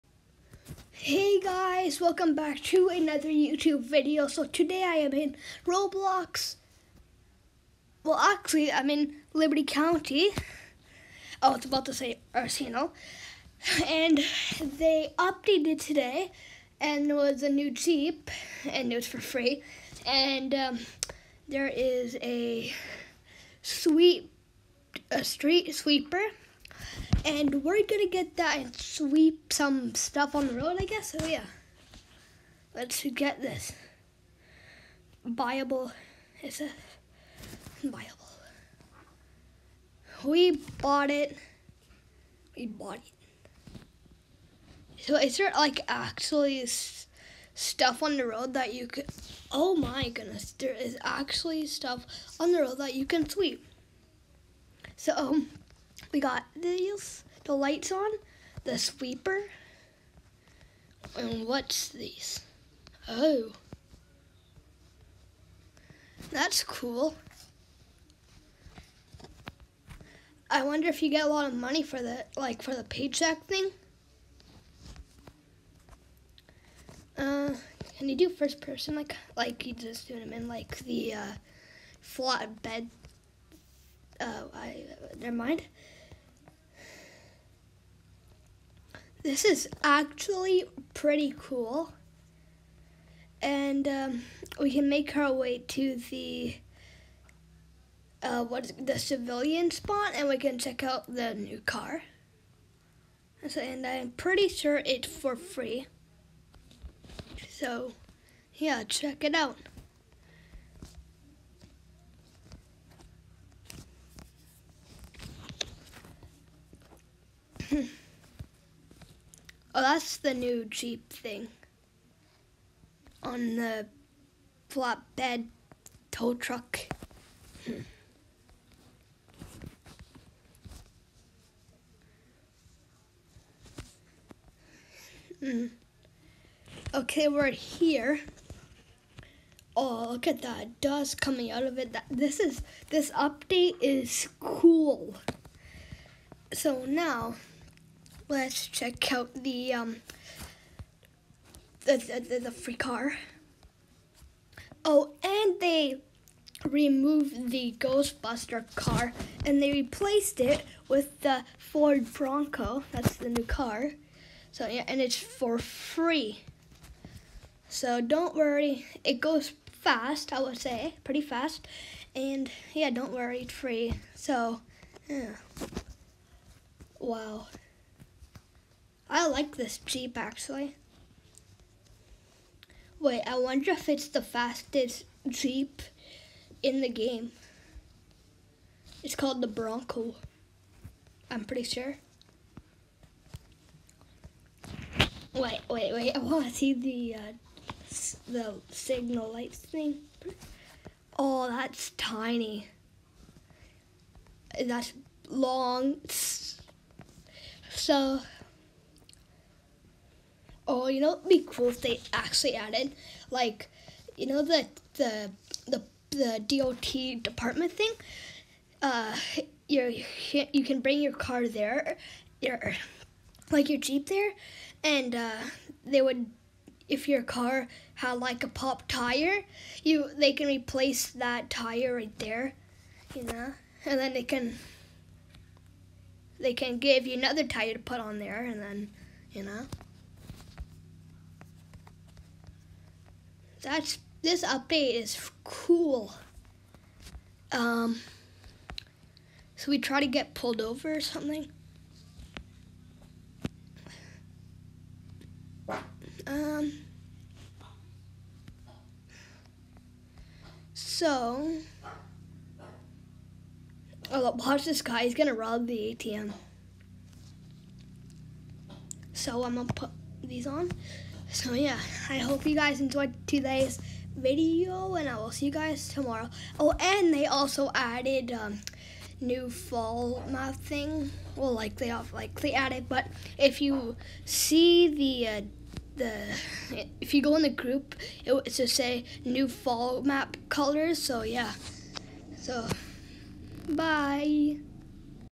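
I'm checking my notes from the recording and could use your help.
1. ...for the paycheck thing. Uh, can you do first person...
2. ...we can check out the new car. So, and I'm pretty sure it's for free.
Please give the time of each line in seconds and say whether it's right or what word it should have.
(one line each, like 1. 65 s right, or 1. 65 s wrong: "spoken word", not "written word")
1. 72 s right
2. 100 s right.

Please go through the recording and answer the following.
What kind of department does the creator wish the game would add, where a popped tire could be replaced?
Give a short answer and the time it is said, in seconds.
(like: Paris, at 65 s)
DOT department, at 216 s.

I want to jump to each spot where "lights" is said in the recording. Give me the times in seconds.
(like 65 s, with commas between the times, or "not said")
57 s, 199 s.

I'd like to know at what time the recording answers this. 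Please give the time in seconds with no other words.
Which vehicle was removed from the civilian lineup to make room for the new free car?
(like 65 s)
157 s.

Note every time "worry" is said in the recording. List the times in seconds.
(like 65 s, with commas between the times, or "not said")
168 s, 173 s.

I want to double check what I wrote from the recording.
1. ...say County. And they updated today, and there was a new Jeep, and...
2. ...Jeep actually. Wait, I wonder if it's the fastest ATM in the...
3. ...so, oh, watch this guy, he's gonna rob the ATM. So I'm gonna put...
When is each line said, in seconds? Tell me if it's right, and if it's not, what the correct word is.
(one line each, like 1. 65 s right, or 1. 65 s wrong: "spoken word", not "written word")
1. 11 s wrong: "Arsenal", not "County"
2. 179 s wrong: "Jeep", not "ATM"
3. 260 s right.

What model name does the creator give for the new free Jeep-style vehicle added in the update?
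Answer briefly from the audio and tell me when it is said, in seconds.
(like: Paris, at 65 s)
Ford Bronco, at 161 s.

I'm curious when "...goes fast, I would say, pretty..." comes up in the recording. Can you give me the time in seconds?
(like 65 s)
169 s.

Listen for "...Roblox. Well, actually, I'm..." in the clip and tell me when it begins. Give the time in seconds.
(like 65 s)
5 s.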